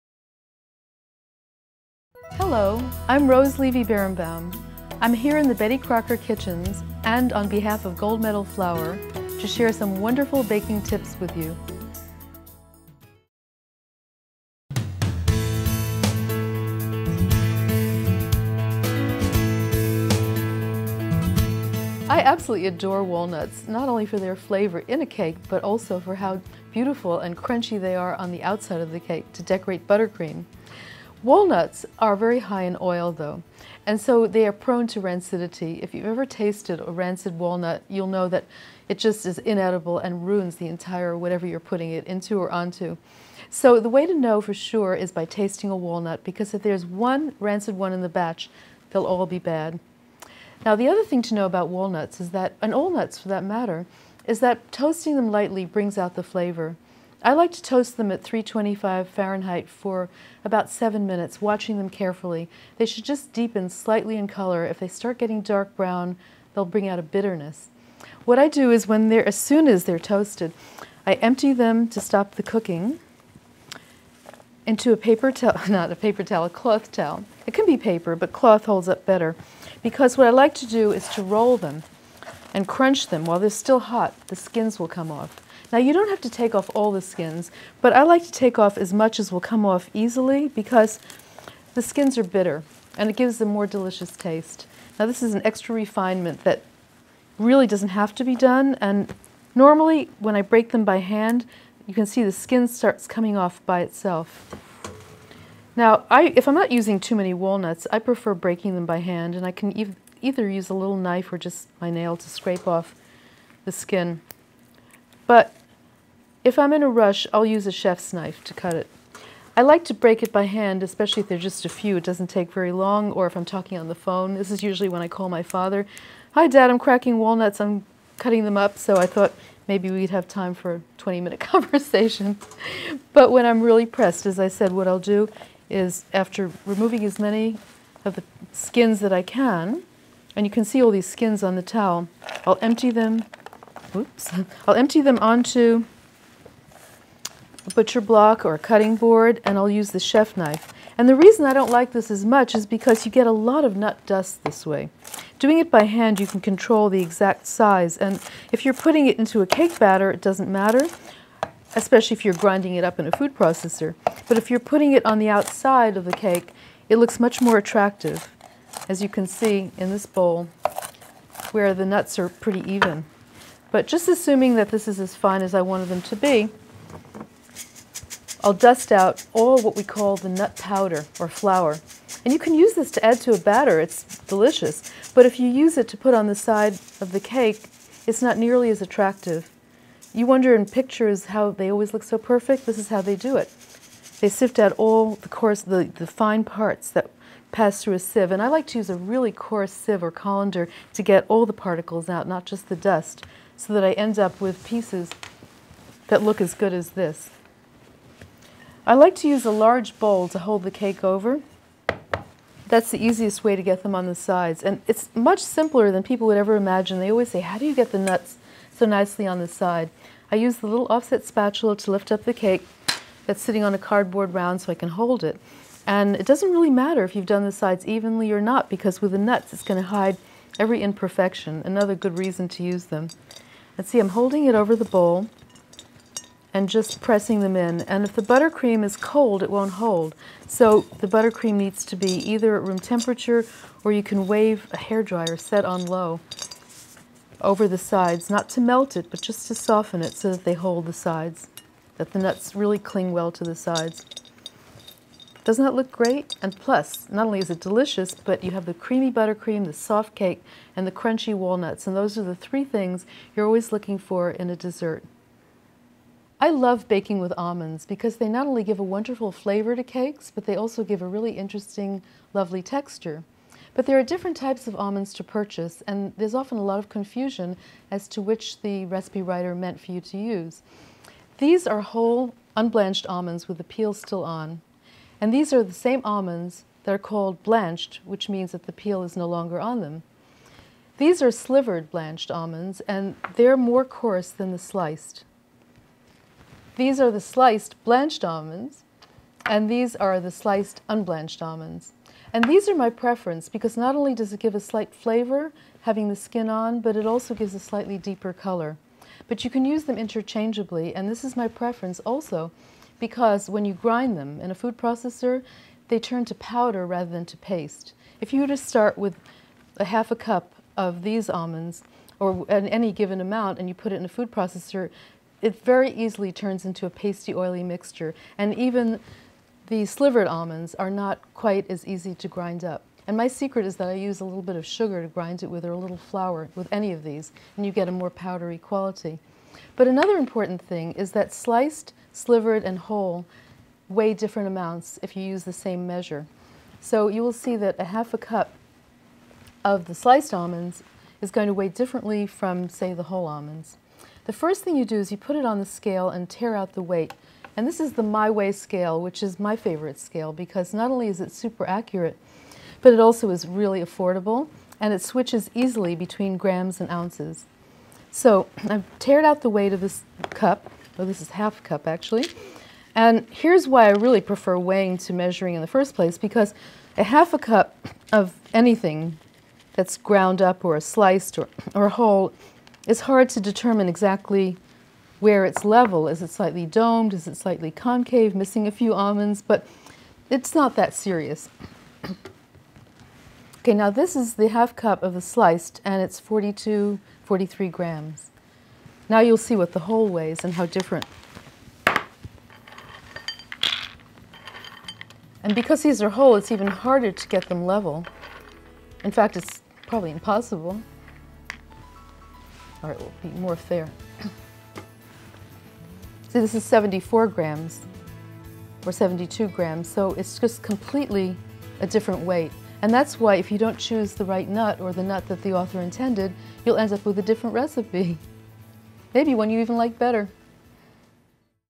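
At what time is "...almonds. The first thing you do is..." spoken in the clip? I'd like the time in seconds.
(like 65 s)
353 s.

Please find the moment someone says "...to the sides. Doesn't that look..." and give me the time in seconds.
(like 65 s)
253 s.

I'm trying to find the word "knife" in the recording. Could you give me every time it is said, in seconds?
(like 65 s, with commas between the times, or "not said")
110 s, 118 s, 150 s.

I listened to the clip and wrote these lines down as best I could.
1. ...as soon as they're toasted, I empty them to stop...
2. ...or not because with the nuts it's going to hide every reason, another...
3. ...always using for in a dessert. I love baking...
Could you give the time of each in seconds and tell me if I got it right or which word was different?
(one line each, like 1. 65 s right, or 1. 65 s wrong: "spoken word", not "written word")
1. 69 s right
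2. 228 s wrong: "imperfection", not "reason"
3. 263 s wrong: "looking", not "using".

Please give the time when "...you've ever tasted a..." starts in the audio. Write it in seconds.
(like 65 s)
35 s.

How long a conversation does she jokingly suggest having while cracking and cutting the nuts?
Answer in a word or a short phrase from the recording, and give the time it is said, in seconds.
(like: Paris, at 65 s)
20-minute, at 130 s.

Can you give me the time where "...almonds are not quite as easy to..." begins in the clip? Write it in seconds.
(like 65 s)
330 s.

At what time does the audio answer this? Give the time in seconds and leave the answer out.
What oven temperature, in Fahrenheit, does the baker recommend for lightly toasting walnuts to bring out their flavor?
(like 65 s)
58 s.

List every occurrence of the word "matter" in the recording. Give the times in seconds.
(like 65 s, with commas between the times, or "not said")
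53 s, 160 s, 226 s.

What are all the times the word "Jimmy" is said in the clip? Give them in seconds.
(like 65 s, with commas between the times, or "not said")
not said.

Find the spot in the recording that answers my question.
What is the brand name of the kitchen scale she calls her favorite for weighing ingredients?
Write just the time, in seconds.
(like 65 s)
358 s.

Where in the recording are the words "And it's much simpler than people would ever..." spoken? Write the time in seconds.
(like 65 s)
214 s.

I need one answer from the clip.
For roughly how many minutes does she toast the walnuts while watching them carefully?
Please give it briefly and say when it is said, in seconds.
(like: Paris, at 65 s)
7 minutes, at 60 s.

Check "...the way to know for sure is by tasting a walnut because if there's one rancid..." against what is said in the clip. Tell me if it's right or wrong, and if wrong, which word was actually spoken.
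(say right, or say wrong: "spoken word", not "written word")
right.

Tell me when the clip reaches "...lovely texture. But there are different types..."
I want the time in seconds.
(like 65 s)
272 s.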